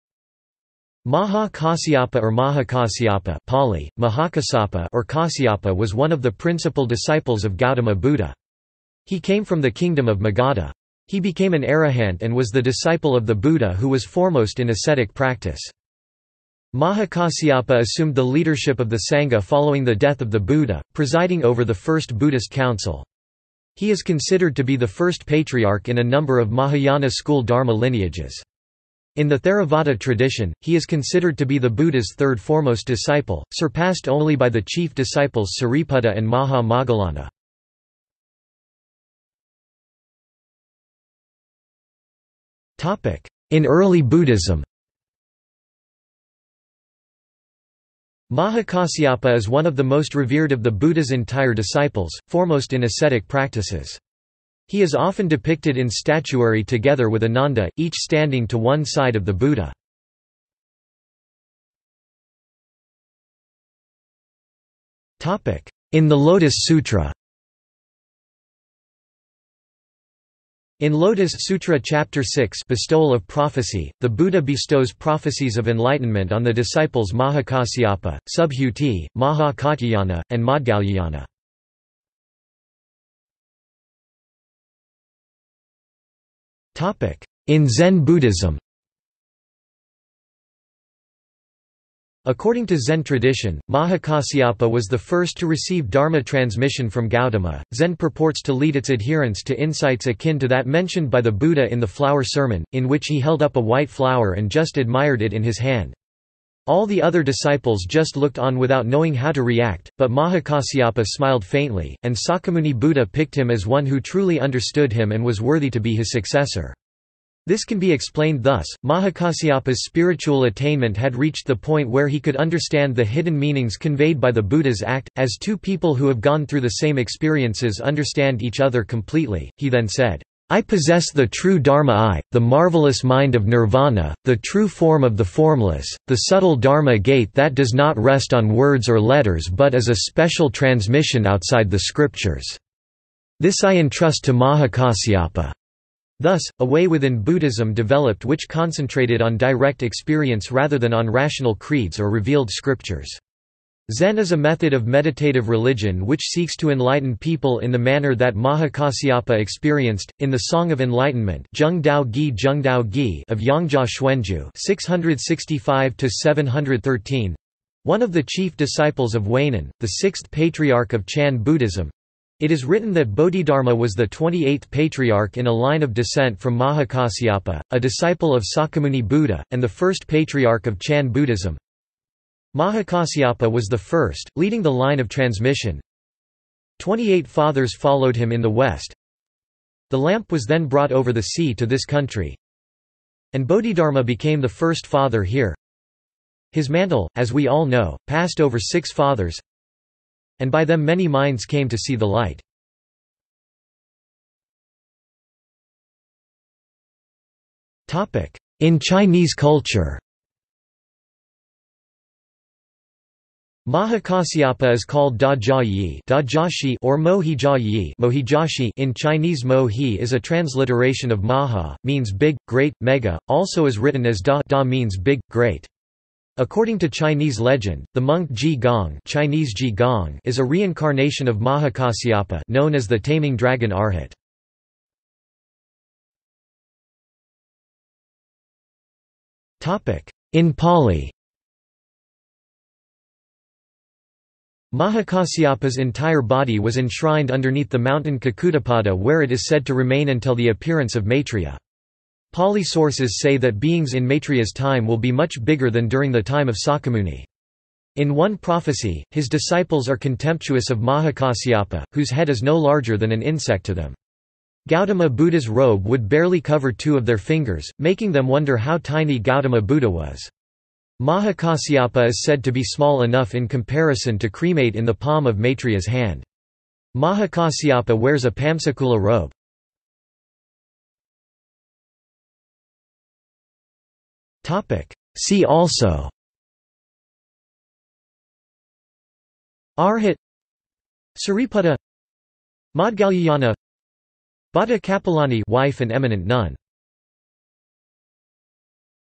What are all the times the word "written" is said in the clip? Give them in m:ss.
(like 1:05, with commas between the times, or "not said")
2:52, 3:43.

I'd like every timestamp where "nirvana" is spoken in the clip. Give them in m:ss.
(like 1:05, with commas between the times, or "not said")
2:13.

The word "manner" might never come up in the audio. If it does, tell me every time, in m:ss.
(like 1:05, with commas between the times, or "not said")
2:37.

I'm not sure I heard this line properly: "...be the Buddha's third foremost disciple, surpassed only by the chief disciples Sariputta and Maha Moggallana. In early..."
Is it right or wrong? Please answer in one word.
right.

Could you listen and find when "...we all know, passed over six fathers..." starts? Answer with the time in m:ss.
3:17.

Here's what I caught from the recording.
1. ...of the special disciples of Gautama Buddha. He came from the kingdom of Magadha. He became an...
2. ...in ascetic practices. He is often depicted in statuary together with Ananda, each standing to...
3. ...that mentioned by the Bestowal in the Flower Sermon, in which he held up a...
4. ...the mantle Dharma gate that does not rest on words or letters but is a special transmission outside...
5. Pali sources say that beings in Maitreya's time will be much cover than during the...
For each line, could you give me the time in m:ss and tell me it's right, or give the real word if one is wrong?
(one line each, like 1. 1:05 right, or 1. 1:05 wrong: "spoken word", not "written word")
1. 0:06 wrong: "principal", not "special"
2. 0:52 right
3. 1:40 wrong: "Buddha", not "Bestowal"
4. 2:16 wrong: "subtle", not "mantle"
5. 4:12 wrong: "bigger", not "cover".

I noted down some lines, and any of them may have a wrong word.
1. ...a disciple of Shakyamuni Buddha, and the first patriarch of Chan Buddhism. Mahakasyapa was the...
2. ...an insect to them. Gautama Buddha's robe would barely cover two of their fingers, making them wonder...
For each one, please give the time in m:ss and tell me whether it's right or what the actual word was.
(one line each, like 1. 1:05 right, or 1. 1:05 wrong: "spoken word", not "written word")
1. 2:57 right
2. 4:23 right.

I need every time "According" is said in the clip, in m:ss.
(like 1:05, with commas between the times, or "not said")
1:32, 3:46.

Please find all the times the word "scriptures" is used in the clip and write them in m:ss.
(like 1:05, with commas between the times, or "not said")
2:21, 2:32.